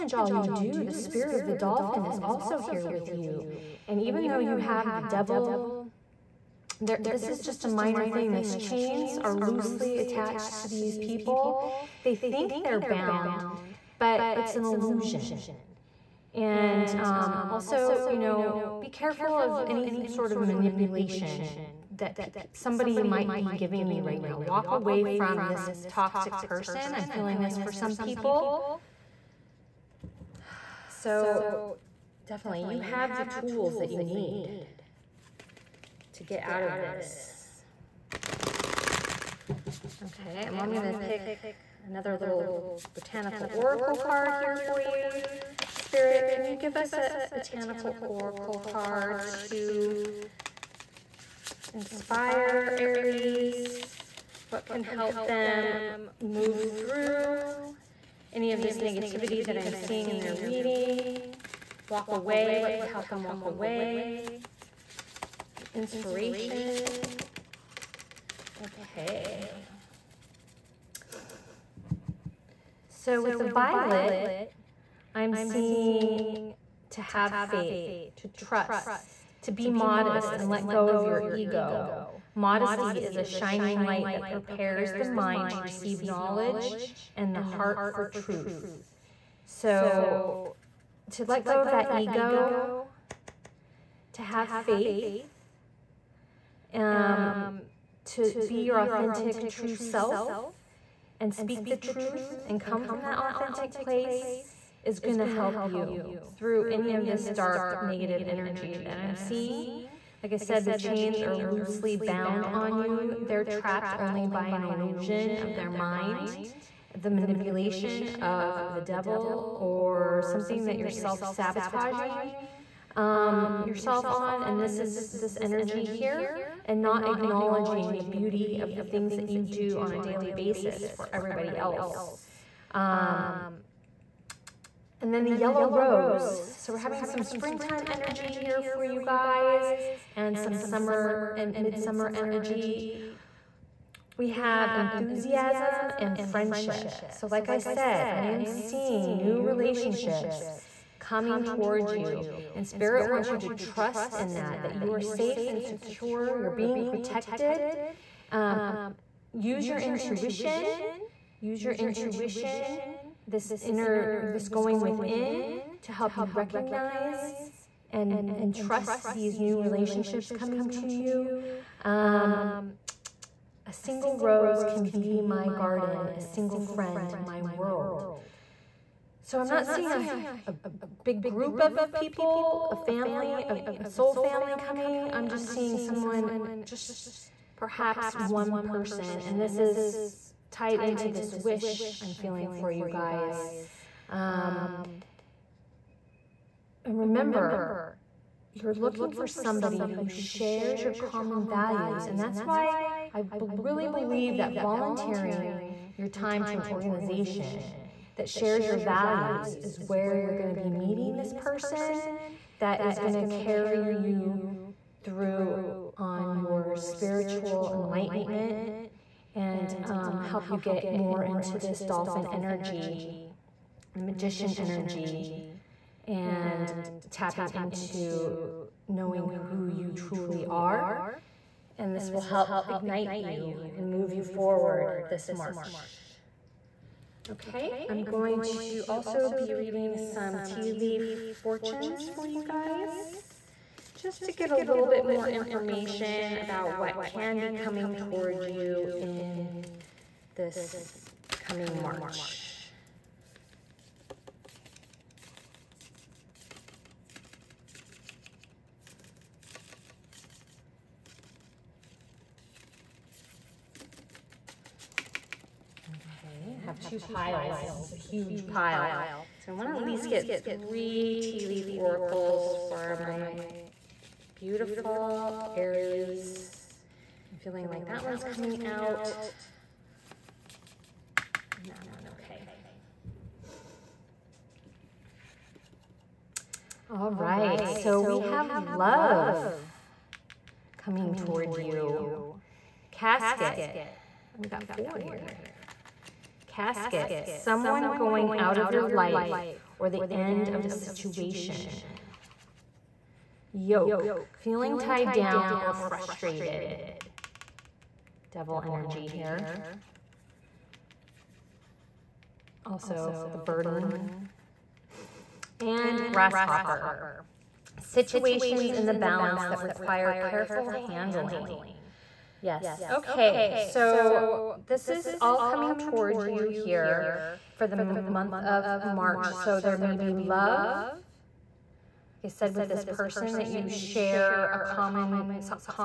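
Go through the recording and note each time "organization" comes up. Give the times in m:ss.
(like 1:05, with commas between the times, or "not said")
3:26.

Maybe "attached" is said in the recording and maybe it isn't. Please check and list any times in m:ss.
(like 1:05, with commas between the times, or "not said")
0:09.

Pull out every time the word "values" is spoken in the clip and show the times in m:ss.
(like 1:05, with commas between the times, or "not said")
3:21, 3:28.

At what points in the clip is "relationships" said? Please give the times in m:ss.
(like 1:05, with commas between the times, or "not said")
2:29, 2:49.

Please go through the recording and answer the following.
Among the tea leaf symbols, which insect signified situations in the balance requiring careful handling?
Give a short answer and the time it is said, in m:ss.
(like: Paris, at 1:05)
Grasshopper, at 5:16.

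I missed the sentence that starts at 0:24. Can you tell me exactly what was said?
Walk away from this toxic person.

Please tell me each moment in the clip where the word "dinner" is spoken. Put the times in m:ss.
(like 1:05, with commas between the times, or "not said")
not said.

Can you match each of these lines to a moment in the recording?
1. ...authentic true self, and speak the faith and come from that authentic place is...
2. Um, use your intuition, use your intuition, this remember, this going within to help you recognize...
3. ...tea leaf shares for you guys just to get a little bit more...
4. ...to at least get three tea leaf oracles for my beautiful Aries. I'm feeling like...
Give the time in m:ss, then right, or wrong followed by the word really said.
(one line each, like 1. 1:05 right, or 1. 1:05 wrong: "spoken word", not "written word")
1. 1:38 wrong: "truth", not "faith"
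2. 2:38 wrong: "inner", not "remember"
3. 4:00 wrong: "fortunes", not "shares"
4. 4:29 right.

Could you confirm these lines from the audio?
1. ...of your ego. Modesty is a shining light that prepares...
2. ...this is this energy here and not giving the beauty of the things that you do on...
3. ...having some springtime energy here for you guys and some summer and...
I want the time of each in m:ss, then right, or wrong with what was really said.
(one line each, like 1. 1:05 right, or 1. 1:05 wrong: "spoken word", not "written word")
1. 1:20 right
2. 2:04 wrong: "acknowledging", not "giving"
3. 2:16 right.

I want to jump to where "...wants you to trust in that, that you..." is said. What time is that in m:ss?
2:33.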